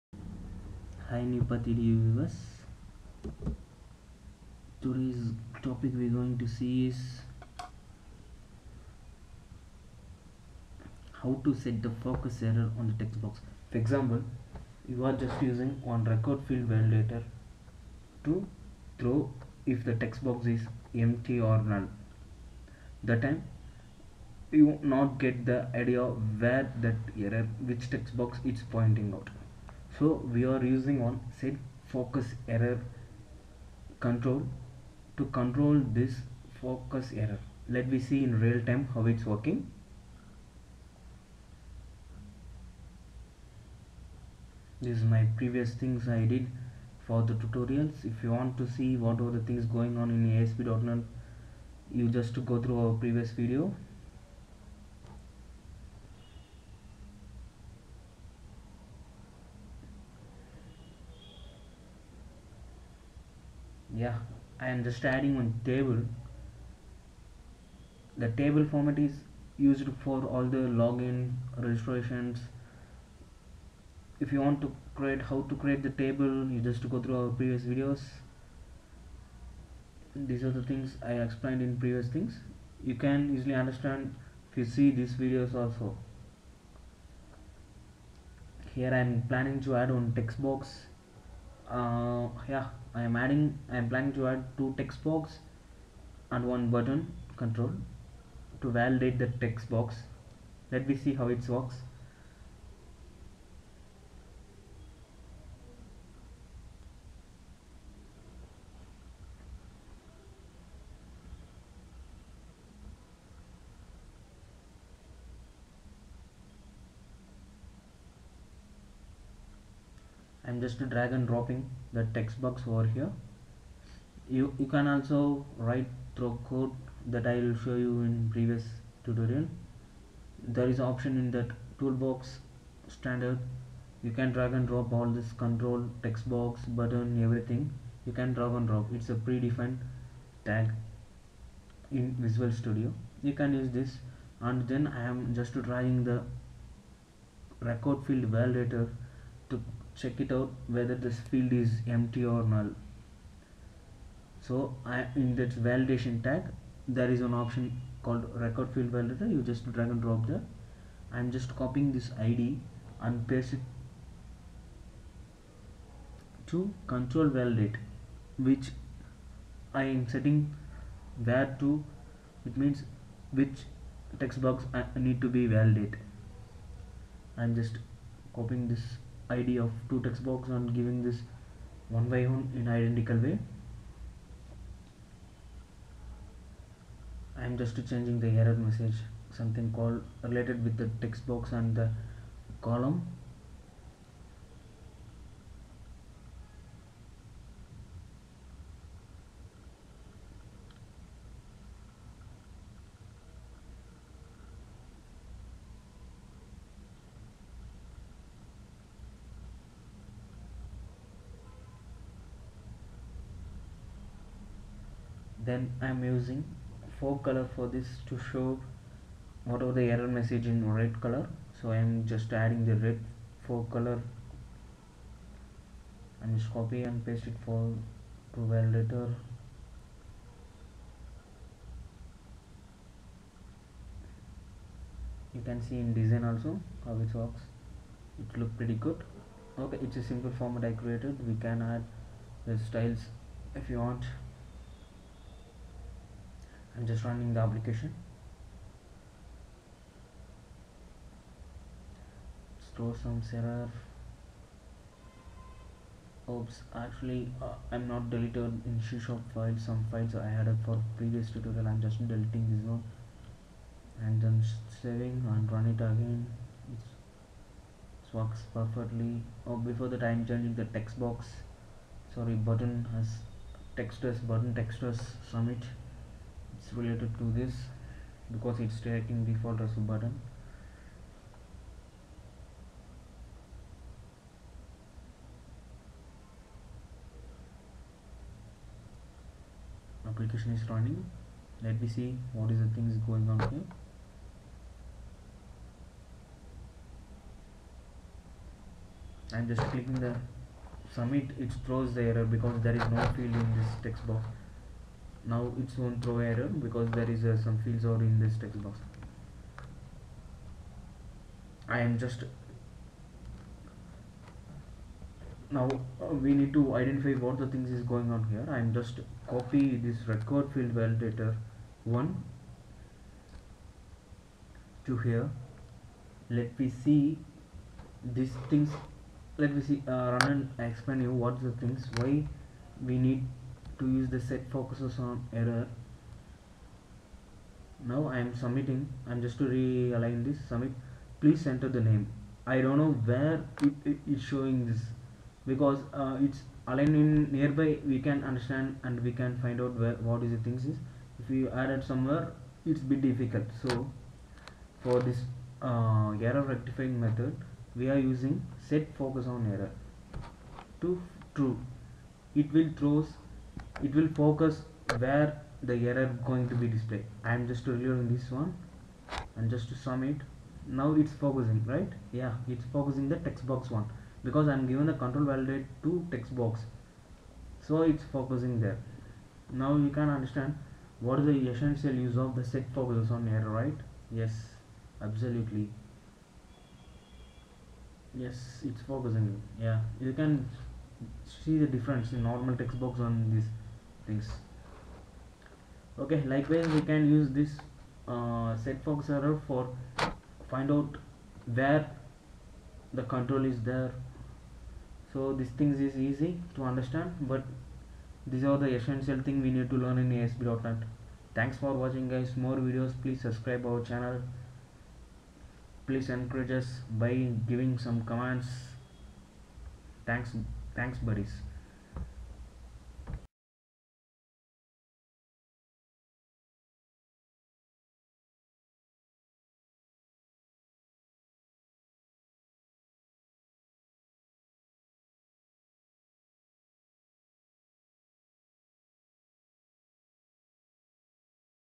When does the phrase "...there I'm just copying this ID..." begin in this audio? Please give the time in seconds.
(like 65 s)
160 s.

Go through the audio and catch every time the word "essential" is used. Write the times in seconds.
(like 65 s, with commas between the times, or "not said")
381 s, 408 s.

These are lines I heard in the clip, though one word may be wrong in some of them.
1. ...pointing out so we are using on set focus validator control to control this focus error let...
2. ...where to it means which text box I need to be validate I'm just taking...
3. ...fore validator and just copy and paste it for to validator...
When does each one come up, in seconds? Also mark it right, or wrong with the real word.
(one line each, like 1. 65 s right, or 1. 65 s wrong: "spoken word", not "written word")
1. 28 s wrong: "error", not "validator"
2. 171 s wrong: "copying", not "taking"
3. 223 s wrong: "color", not "validator".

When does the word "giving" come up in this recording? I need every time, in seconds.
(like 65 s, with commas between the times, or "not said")
180 s, 417 s.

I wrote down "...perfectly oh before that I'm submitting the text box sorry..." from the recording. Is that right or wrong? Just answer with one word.
wrong.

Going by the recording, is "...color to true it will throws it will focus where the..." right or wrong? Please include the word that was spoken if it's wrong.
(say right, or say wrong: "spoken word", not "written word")
wrong: "error", not "color".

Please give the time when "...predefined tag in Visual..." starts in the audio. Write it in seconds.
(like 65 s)
139 s.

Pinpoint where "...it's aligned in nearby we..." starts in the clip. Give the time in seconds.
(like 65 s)
346 s.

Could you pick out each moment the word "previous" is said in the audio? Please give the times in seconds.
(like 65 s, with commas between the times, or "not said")
45 s, 53 s, 77 s, 81 s, 128 s, 260 s.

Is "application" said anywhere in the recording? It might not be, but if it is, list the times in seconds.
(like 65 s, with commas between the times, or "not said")
247 s, 290 s.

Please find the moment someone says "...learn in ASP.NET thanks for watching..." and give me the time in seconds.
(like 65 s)
409 s.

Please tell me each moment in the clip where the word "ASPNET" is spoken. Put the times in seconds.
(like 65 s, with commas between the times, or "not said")
50 s, 410 s.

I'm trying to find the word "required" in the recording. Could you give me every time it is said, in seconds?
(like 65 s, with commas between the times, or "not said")
16 s, 147 s, 158 s, 320 s.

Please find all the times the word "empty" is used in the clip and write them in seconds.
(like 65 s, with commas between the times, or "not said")
21 s, 151 s.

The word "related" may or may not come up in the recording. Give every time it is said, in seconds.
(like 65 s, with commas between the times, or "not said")
190 s, 276 s.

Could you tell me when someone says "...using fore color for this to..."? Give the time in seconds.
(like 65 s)
216 s.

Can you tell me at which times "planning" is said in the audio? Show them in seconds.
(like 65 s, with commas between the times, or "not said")
89 s, 93 s.